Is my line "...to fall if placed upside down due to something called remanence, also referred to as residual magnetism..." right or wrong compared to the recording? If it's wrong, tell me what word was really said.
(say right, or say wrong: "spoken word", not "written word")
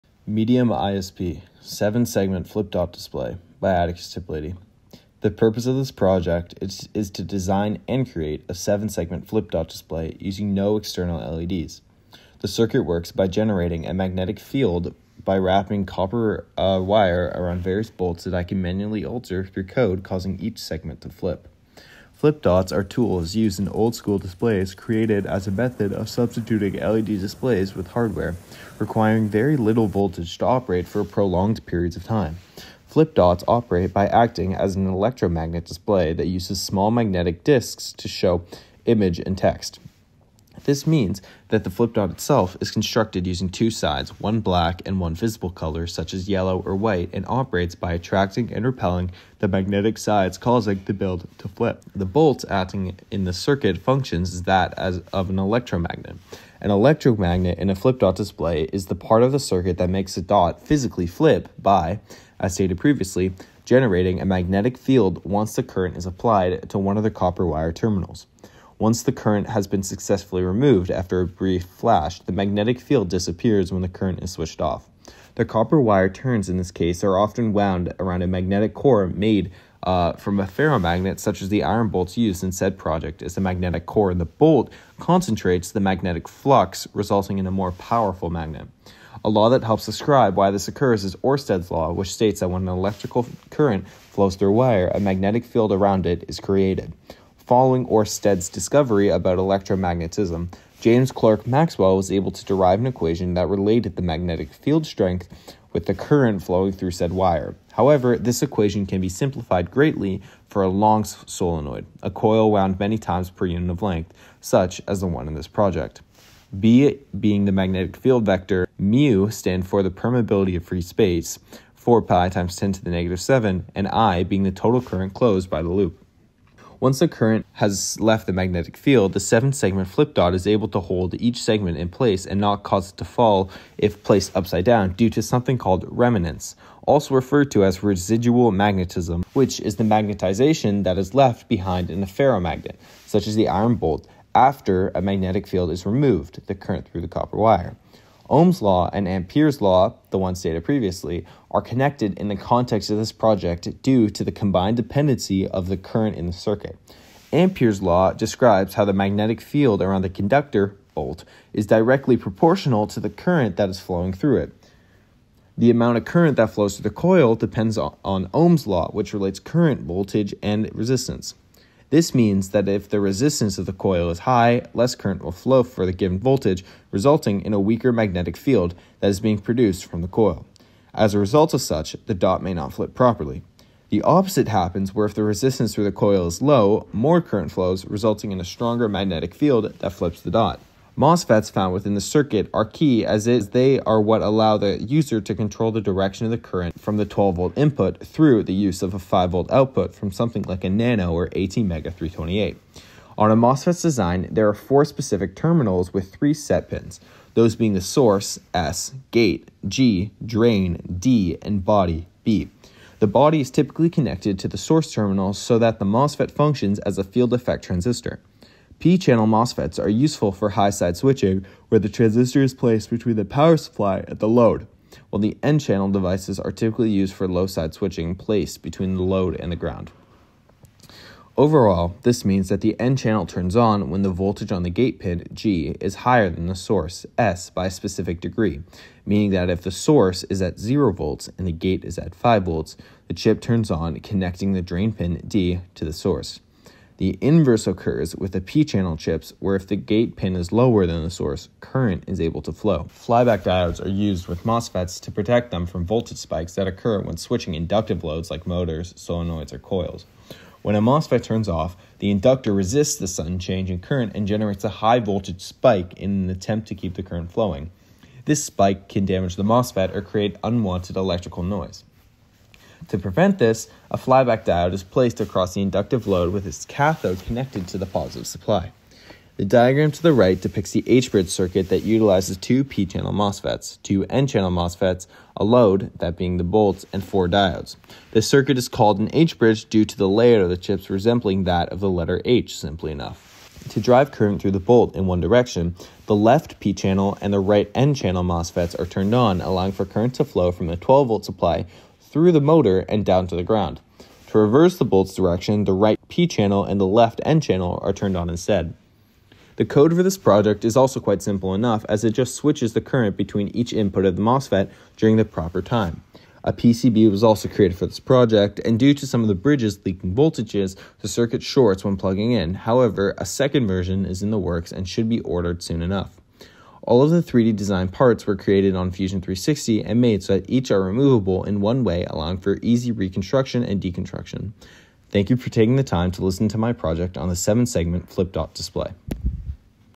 right.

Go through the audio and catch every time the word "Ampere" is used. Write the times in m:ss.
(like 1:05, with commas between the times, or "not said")
2:29, 2:37.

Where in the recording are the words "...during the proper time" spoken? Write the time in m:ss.
5:14.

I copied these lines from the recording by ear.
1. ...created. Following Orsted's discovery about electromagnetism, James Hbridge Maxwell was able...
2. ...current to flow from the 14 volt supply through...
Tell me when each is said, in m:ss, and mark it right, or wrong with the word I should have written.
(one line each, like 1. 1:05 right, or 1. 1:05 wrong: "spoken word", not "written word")
1. 1:36 wrong: "Clerk", not "Hbridge"
2. 4:59 wrong: "12", not "14".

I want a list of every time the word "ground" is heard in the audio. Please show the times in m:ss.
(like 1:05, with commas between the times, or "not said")
3:49, 5:03.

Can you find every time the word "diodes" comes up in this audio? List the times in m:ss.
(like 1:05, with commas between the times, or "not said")
4:13, 4:34, 4:47.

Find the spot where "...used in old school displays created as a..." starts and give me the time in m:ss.
0:23.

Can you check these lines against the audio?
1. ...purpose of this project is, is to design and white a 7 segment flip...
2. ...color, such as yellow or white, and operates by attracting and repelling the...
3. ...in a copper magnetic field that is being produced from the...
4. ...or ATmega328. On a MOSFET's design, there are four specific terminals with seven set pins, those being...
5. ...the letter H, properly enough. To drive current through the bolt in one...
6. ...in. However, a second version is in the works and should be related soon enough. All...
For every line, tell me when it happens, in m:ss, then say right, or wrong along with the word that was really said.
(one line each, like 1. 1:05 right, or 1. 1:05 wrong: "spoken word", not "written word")
1. 0:05 wrong: "create", not "white"
2. 0:45 right
3. 2:57 wrong: "weaker", not "copper"
4. 3:21 wrong: "three", not "seven"
5. 4:51 wrong: "simply", not "properly"
6. 5:22 wrong: "ordered", not "related".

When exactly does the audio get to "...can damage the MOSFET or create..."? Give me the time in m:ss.
4:28.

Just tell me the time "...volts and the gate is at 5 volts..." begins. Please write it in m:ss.
4:00.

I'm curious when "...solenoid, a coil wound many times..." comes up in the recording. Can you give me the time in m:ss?
1:51.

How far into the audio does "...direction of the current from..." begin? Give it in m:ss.
3:15.